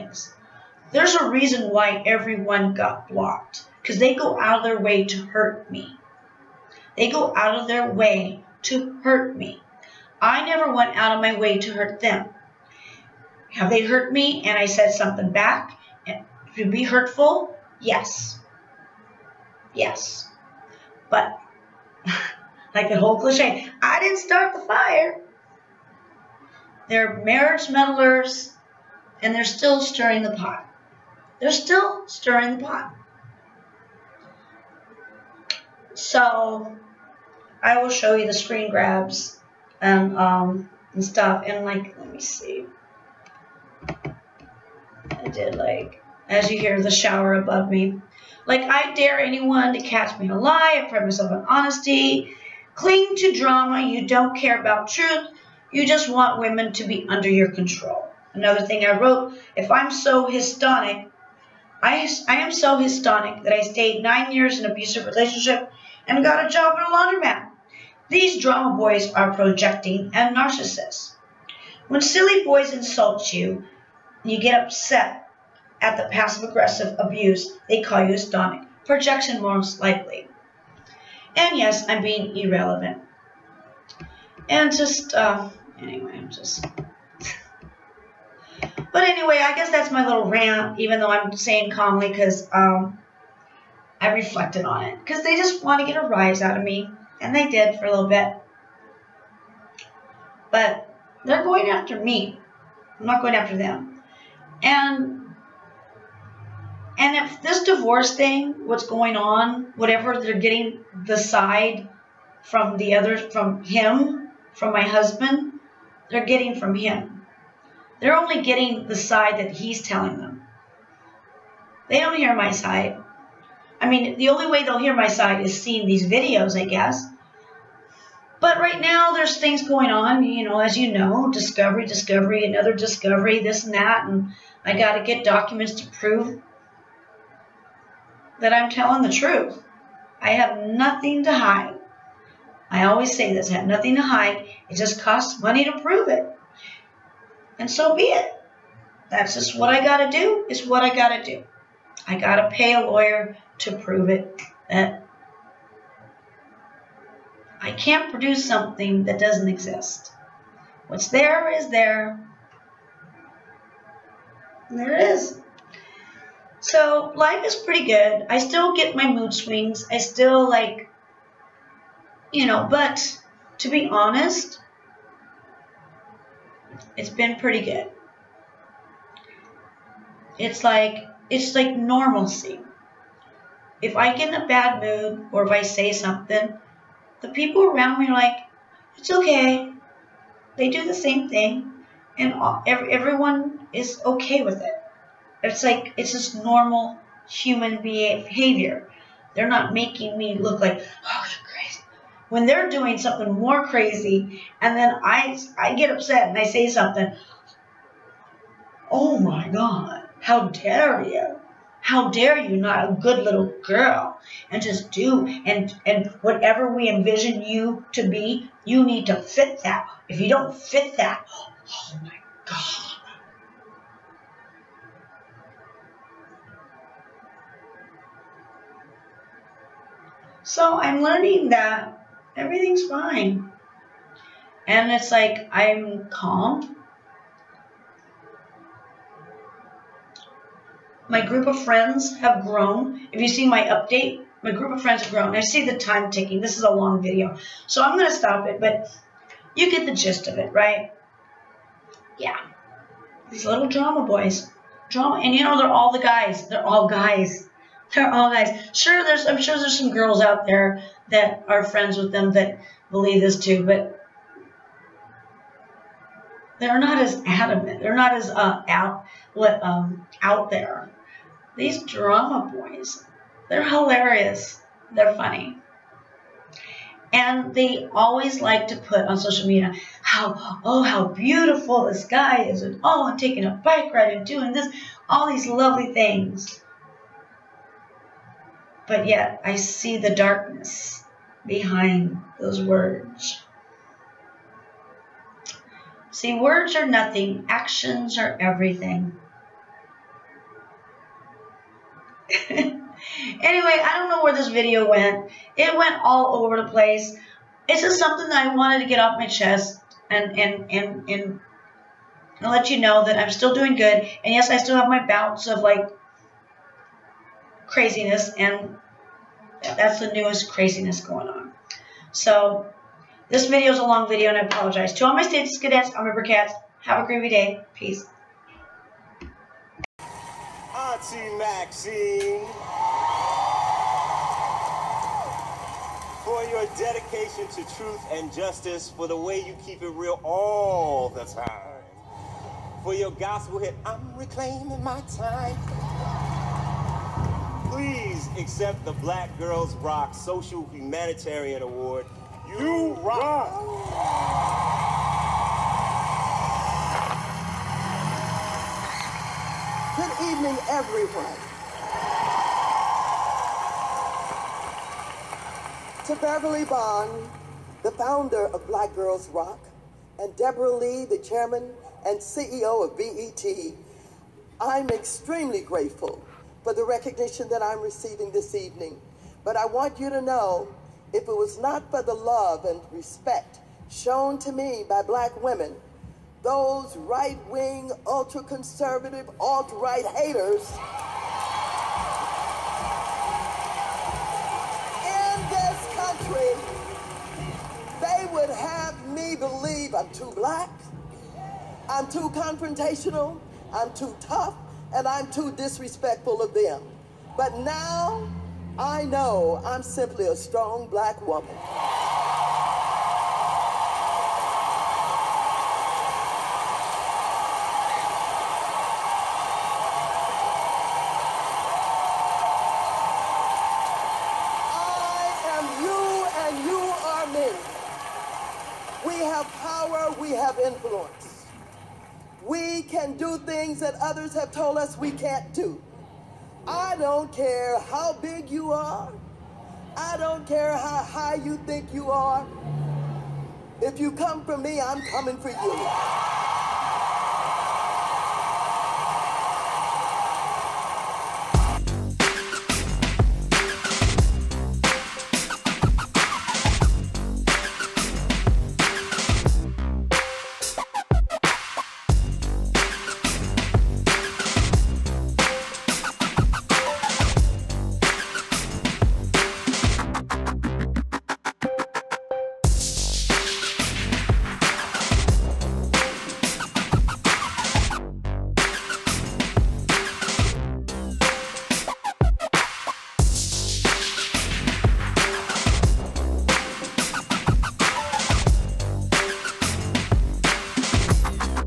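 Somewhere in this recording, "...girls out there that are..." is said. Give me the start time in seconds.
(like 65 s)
259 s.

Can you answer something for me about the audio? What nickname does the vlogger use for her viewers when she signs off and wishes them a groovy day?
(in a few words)
Stace-Cadets.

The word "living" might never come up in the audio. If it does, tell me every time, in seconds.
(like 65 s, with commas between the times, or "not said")
not said.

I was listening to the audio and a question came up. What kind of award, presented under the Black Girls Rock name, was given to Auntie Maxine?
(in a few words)
Social Humanitarian Award.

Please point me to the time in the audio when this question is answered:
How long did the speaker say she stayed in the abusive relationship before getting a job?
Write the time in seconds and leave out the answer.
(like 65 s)
64 s.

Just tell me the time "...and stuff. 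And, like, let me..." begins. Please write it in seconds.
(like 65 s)
40 s.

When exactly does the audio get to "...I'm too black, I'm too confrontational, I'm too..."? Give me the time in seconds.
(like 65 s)
399 s.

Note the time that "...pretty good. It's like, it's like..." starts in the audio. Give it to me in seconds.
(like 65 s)
177 s.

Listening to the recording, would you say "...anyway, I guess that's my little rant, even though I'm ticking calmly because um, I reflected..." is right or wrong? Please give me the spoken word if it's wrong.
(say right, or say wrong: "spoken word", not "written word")
wrong: "saying", not "ticking".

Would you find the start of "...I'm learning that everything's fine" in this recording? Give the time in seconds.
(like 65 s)
230 s.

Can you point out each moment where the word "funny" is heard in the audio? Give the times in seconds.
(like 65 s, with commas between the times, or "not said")
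275 s.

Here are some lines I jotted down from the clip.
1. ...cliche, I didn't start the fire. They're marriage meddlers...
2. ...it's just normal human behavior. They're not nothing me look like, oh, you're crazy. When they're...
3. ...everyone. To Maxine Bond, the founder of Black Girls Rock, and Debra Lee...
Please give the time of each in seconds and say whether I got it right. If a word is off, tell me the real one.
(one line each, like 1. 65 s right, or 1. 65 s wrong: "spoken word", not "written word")
1. 23 s right
2. 195 s wrong: "making", not "nothing"
3. 360 s wrong: "Beverly", not "Maxine".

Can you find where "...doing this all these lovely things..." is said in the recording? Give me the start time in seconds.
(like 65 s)
284 s.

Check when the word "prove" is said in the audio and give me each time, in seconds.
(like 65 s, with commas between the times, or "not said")
135 s, 145 s, 153 s.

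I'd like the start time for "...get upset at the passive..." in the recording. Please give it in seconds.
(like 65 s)
74 s.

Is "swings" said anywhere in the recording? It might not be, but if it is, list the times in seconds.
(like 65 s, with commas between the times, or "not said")
169 s.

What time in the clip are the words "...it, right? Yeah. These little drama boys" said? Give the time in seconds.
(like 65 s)
250 s.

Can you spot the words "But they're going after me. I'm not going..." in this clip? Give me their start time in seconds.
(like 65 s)
100 s.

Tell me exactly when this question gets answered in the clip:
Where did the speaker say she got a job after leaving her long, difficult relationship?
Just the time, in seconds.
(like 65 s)
66 s.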